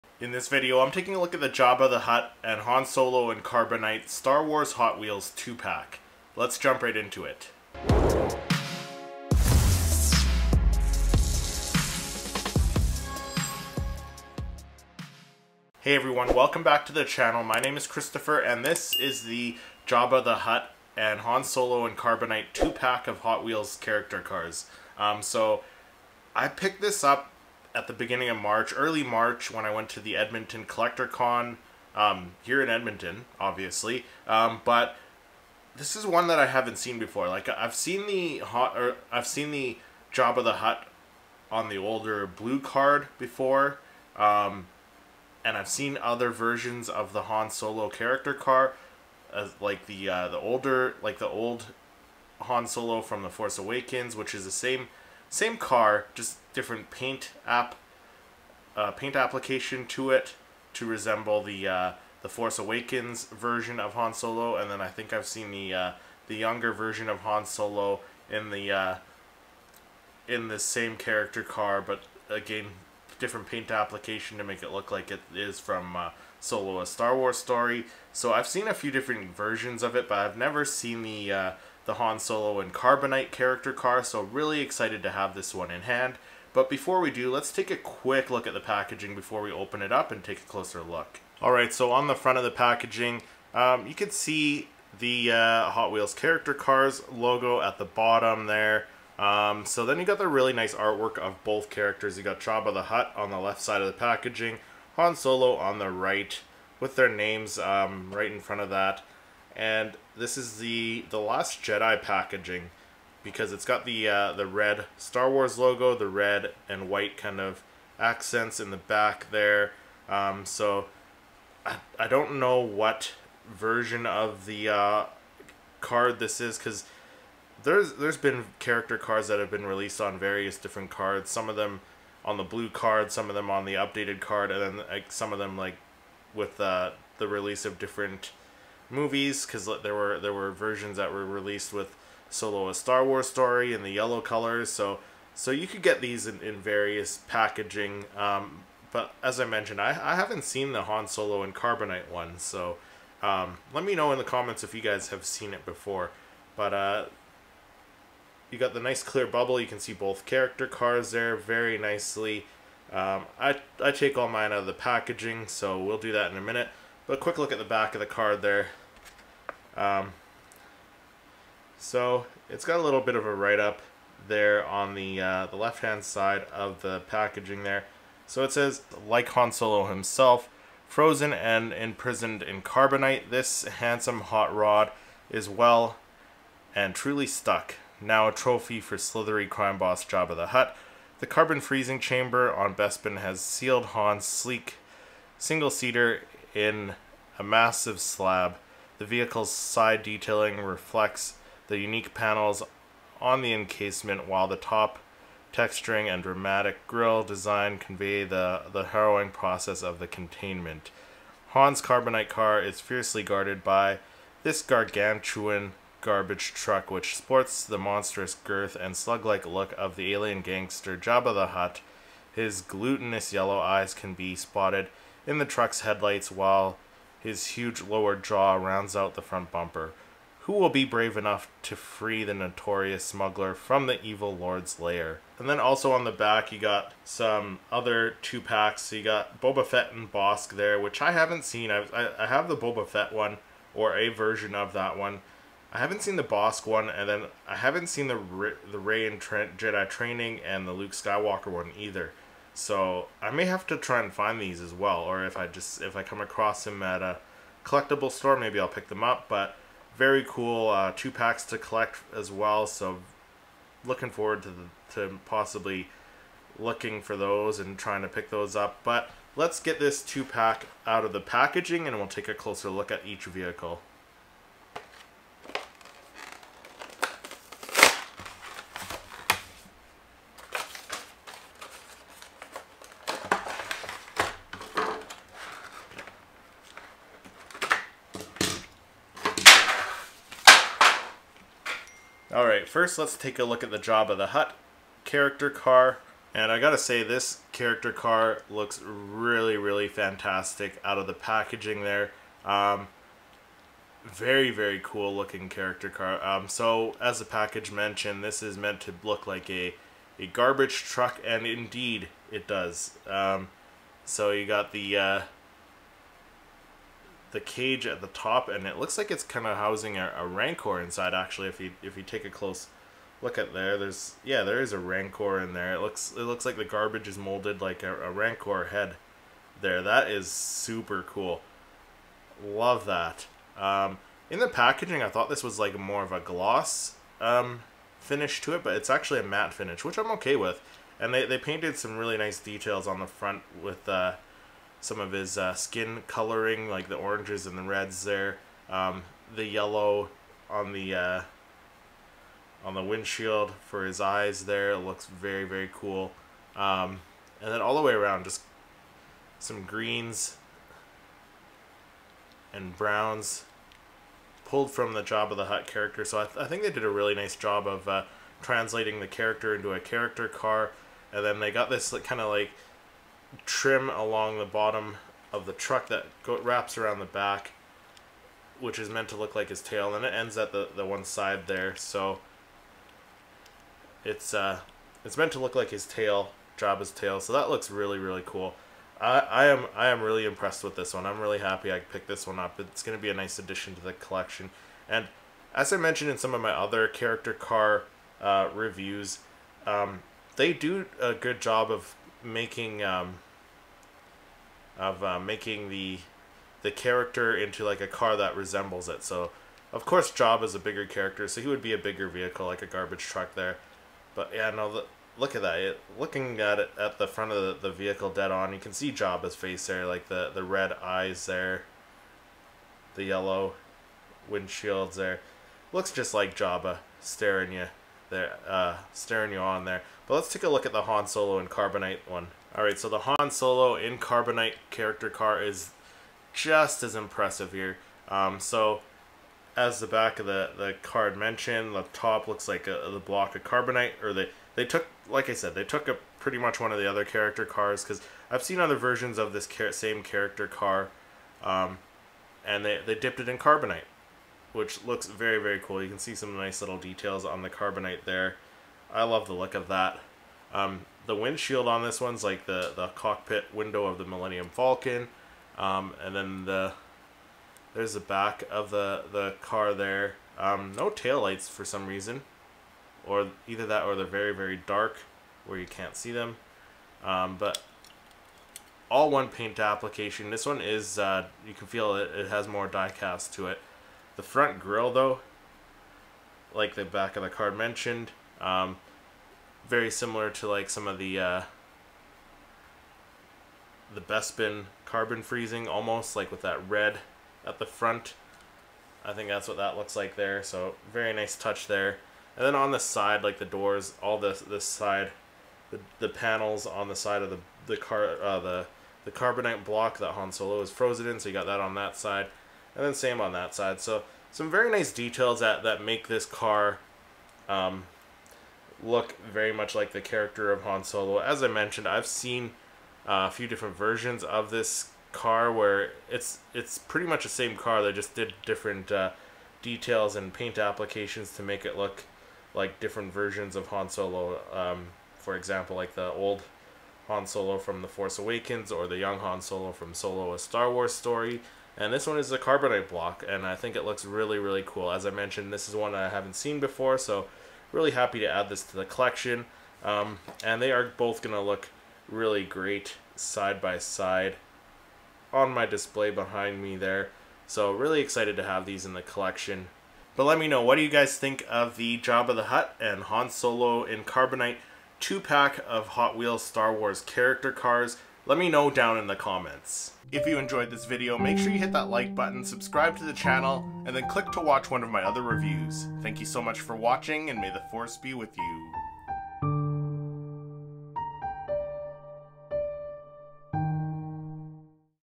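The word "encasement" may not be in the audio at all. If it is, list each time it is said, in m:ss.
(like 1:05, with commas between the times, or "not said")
3:23.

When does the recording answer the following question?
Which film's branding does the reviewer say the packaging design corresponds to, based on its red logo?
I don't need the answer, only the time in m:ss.
1:51.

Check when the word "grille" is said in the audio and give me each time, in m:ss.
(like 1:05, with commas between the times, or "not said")
3:26, 8:04.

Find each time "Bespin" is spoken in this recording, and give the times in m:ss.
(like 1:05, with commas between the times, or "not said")
3:12, 8:13.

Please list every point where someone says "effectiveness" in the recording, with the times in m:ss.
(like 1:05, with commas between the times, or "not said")
not said.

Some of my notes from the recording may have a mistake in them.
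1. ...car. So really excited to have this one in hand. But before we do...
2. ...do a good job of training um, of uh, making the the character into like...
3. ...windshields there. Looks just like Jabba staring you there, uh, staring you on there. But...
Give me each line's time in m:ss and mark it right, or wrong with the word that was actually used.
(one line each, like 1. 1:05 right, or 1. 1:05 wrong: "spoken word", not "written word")
1. 1:23 right
2. 6:40 wrong: "making", not "training"
3. 7:04 right.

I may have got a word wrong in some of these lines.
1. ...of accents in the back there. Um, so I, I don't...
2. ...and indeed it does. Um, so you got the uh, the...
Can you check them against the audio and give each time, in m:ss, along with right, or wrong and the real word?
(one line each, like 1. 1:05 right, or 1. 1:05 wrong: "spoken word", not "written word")
1. 1:57 right
2. 5:11 right.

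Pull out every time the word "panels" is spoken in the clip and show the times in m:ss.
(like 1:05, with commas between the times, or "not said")
3:22, 8:26.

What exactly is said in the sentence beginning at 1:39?
Um, so then you got the really nice artwork of both characters.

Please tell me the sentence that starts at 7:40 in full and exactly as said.
Um, the windshield on this one's like the, the cockpit window of the Millennium Falcon.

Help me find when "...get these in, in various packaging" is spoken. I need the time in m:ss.
2:25.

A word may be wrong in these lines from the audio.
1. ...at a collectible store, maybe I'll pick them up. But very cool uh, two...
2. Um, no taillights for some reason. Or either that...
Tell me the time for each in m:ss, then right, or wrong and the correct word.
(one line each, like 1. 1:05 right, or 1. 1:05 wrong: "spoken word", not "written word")
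1. 4:16 right
2. 7:50 right.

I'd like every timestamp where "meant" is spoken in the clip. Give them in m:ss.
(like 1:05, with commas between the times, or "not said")
5:08, 6:18, 6:25.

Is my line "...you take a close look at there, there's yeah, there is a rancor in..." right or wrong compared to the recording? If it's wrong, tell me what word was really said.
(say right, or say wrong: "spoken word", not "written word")
right.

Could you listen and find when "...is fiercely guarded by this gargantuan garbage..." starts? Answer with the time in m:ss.
3:32.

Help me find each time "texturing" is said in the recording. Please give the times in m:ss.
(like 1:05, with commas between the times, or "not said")
3:25.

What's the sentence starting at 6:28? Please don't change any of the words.
I, I am I am really impressed with this one.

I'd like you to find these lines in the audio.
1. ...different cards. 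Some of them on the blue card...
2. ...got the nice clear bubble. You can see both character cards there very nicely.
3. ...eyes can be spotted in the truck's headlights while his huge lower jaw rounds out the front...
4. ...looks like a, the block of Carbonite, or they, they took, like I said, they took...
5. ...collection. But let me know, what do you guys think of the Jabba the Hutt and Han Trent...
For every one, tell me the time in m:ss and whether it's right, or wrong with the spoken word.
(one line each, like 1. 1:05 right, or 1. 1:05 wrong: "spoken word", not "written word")
1. 2:10 right
2. 2:38 right
3. 3:43 right
4. 7:22 right
5. 9:19 wrong: "Solo", not "Trent".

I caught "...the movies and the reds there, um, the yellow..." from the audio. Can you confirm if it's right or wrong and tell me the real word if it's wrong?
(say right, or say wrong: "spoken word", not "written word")
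wrong: "oranges", not "movies".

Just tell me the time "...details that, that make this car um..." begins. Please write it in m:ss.
8:34.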